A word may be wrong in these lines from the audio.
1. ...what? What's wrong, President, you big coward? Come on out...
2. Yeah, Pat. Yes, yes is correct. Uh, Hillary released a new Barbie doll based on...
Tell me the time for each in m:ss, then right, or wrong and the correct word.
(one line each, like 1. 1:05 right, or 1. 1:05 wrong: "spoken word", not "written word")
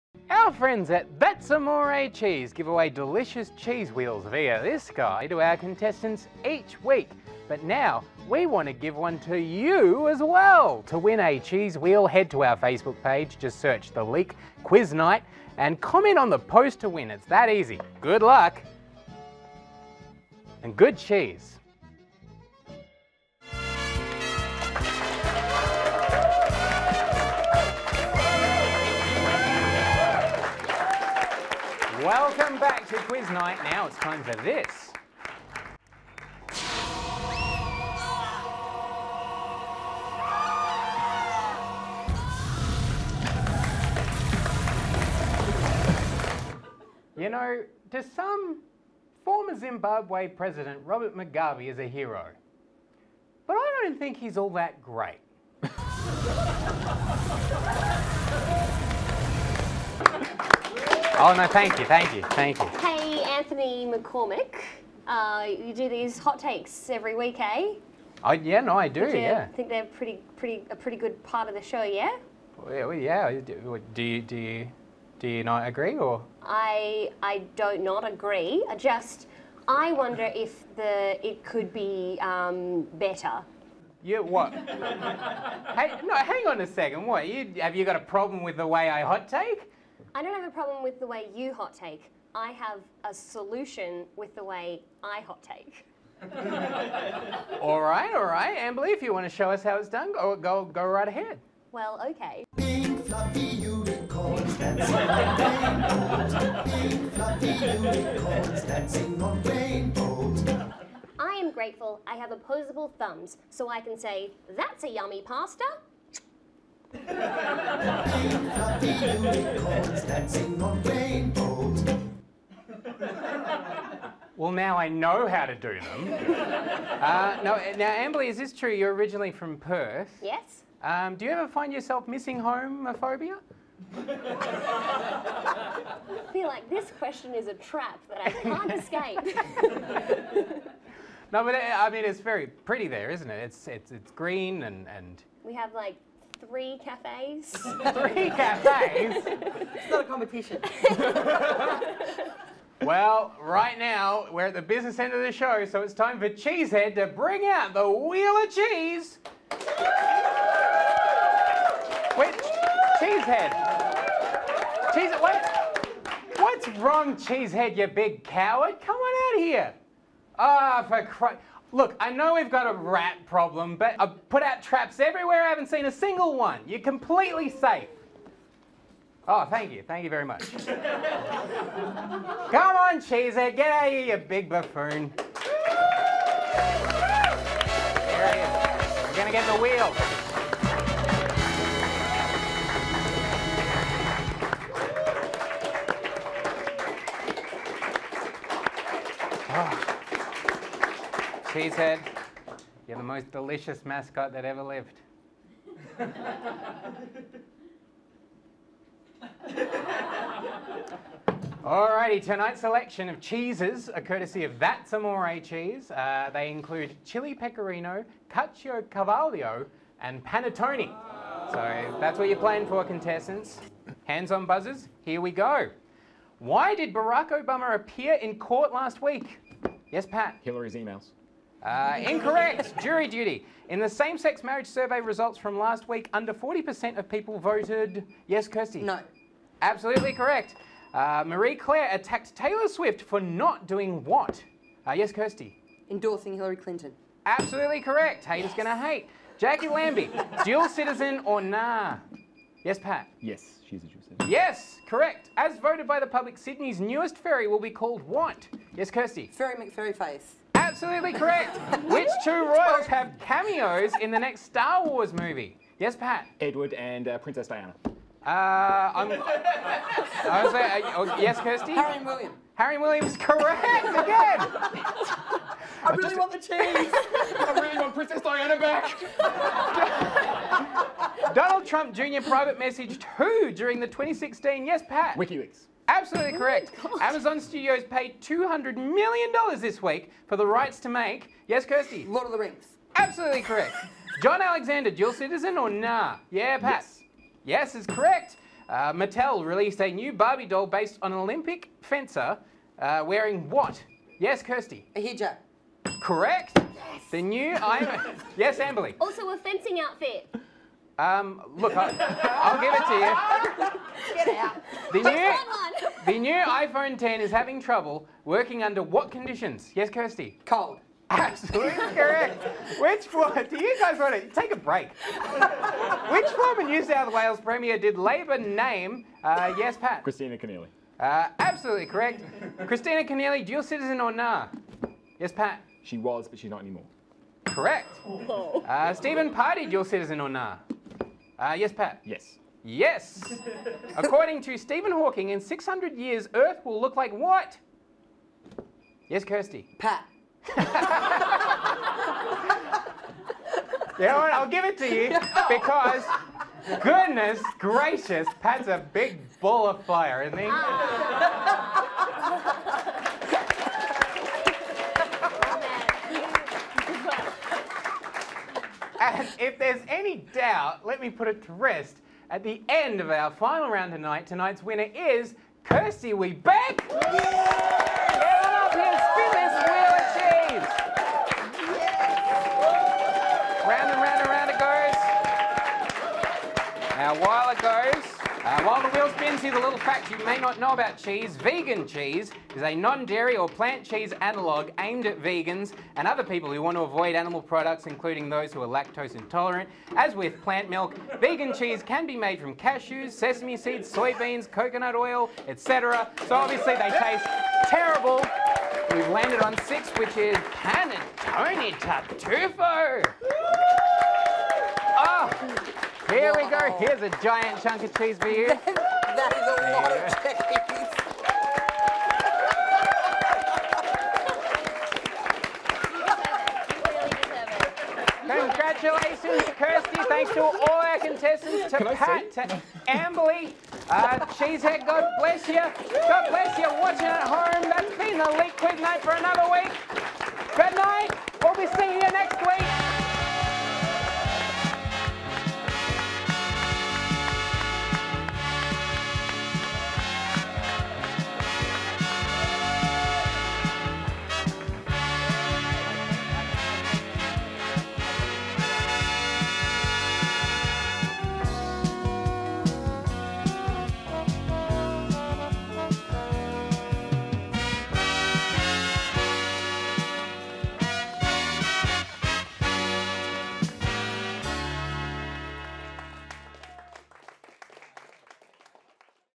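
1. 2:45 wrong: "Cheesehead", not "President"
2. 4:56 wrong: "Mattel", not "Hillary".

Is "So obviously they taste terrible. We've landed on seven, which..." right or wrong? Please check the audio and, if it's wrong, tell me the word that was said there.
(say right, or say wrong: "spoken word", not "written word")
wrong: "six", not "seven".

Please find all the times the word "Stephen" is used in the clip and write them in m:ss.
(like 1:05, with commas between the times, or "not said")
5:38, 5:44.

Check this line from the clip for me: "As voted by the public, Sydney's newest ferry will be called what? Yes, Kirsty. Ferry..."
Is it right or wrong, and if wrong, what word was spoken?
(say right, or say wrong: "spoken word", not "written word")
right.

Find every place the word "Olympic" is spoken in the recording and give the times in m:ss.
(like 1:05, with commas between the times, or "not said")
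5:01.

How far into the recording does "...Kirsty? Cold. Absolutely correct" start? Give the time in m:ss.
5:19.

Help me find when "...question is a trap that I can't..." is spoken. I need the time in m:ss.
2:16.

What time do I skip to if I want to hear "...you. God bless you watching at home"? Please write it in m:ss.
7:15.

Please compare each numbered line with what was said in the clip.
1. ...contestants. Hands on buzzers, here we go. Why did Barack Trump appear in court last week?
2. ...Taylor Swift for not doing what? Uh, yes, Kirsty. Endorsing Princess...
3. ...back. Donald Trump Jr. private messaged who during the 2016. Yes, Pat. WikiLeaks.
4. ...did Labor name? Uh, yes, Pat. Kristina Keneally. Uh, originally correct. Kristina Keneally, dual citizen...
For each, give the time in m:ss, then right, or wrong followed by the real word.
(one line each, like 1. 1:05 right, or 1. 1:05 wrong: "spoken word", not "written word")
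1. 3:42 wrong: "Obama", not "Trump"
2. 4:02 wrong: "Hillary", not "Princess"
3. 4:38 right
4. 5:27 wrong: "absolutely", not "originally".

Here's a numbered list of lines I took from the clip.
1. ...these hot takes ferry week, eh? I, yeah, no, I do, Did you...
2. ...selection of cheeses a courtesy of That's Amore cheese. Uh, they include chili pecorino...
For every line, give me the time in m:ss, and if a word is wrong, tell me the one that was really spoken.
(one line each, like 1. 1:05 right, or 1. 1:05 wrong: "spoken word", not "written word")
1. 1:05 wrong: "every", not "ferry"
2. 3:32 right.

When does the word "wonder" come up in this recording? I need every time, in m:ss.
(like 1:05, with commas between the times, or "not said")
1:19.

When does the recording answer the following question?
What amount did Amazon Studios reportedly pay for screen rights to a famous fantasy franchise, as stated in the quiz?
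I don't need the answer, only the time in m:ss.
4:48.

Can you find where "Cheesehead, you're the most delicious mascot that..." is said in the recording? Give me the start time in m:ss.
3:21.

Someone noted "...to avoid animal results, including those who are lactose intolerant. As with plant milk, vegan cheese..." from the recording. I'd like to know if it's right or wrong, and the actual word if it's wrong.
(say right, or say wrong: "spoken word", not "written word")
wrong: "products", not "results".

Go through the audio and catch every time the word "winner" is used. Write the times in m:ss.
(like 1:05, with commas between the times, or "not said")
6:14.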